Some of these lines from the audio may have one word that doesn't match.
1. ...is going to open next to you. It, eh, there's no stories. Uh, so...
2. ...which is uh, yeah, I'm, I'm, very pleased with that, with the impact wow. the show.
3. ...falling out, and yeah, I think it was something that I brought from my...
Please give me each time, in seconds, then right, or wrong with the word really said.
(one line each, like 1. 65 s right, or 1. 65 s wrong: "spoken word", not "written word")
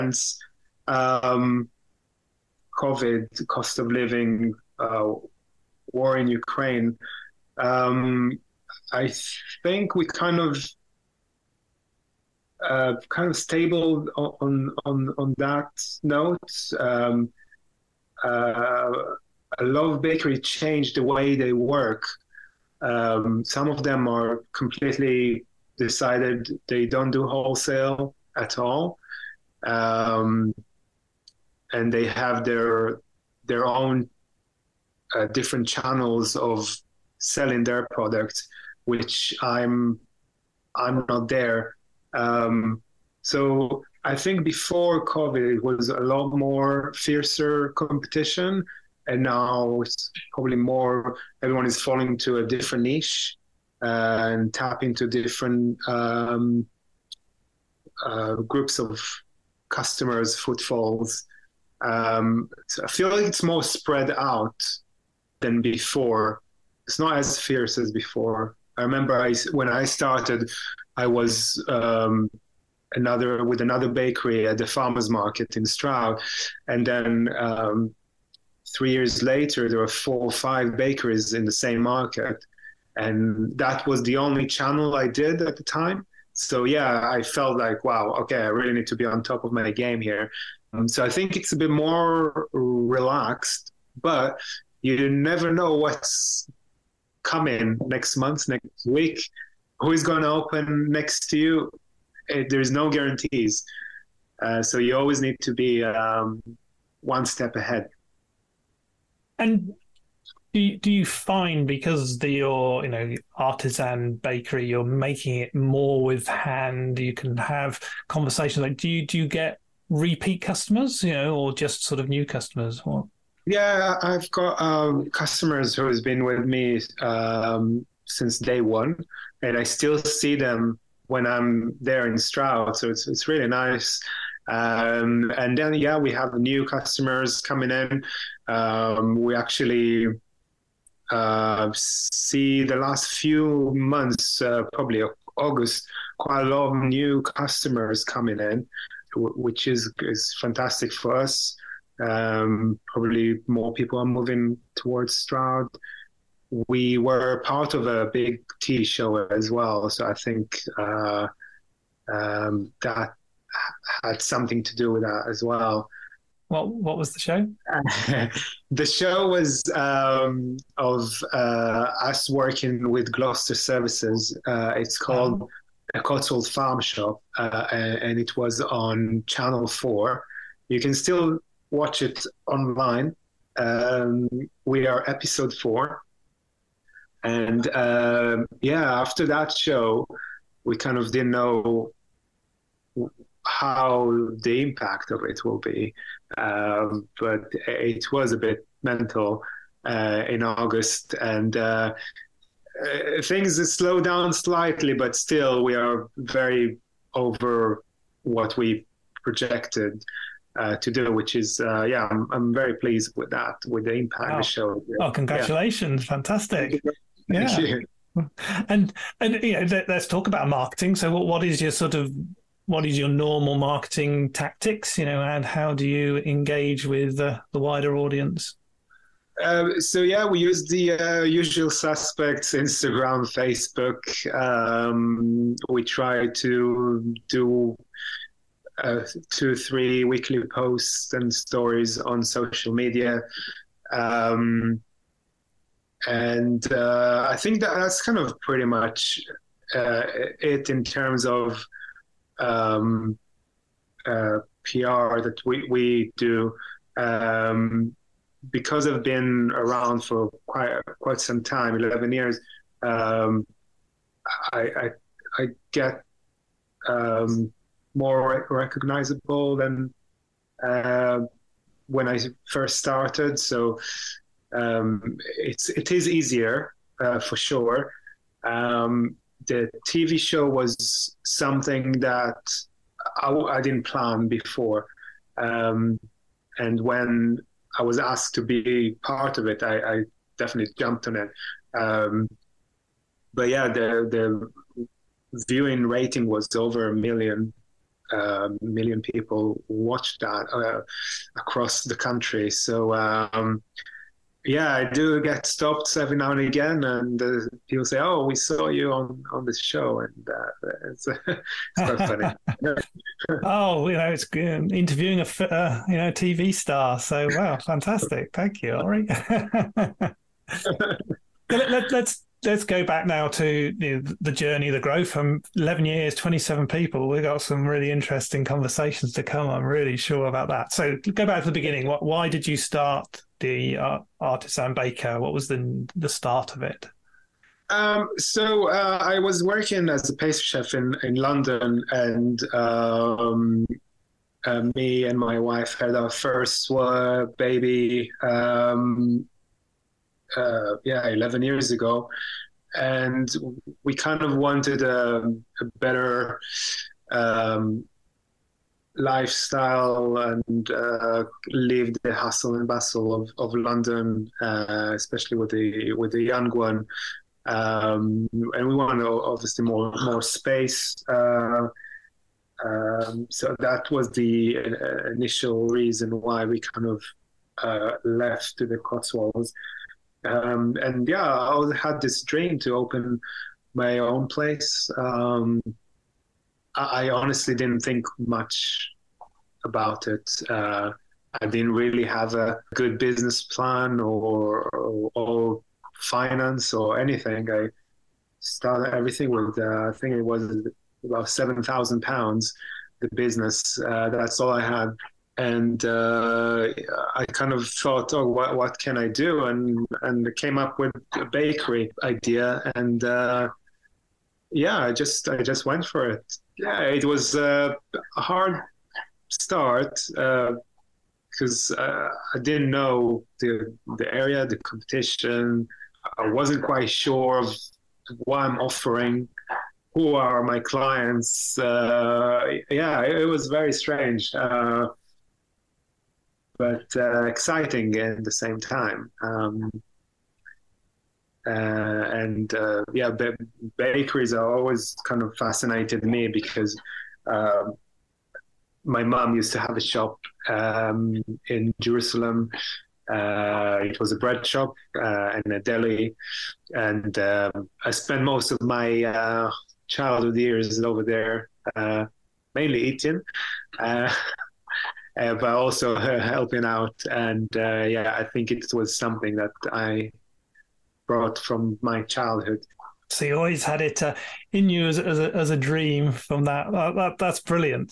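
1. 99 s wrong: "guarantees", not "stories"
2. 211 s right
3. 465 s wrong: "helping", not "falling".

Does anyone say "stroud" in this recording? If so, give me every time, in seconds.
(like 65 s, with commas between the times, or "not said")
75 s, 132 s, 155 s.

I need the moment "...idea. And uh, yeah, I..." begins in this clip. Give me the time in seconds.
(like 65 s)
412 s.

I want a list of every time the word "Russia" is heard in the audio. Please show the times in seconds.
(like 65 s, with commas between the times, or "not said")
not said.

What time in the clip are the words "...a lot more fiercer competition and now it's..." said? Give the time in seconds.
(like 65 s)
45 s.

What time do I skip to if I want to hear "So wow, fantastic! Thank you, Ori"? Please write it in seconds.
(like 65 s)
316 s.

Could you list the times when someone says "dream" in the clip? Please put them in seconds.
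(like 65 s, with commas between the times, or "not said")
382 s, 475 s.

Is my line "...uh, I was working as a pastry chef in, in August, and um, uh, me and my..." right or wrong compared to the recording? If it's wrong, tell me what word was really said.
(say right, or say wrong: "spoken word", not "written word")
wrong: "London", not "August".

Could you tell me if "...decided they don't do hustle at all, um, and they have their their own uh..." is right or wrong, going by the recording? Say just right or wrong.
wrong.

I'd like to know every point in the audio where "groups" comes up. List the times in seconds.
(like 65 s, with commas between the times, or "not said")
58 s.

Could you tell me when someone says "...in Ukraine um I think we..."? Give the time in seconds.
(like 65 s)
6 s.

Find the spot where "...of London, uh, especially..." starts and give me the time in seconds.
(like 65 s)
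363 s.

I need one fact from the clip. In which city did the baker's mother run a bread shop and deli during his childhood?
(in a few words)
Jerusalem.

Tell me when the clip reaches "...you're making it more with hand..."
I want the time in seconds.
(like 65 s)
114 s.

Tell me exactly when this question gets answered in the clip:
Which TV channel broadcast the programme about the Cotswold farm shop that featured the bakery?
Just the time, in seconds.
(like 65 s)
179 s.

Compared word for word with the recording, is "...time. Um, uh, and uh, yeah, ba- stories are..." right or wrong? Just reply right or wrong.
wrong.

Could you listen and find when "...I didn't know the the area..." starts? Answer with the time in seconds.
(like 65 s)
422 s.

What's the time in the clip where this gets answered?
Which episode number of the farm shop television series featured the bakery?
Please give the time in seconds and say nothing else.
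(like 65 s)
185 s.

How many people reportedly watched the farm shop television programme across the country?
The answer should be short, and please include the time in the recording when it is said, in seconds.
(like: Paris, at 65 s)
over a million, at 296 s.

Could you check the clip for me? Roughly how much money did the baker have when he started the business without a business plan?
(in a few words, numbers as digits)
£7,000.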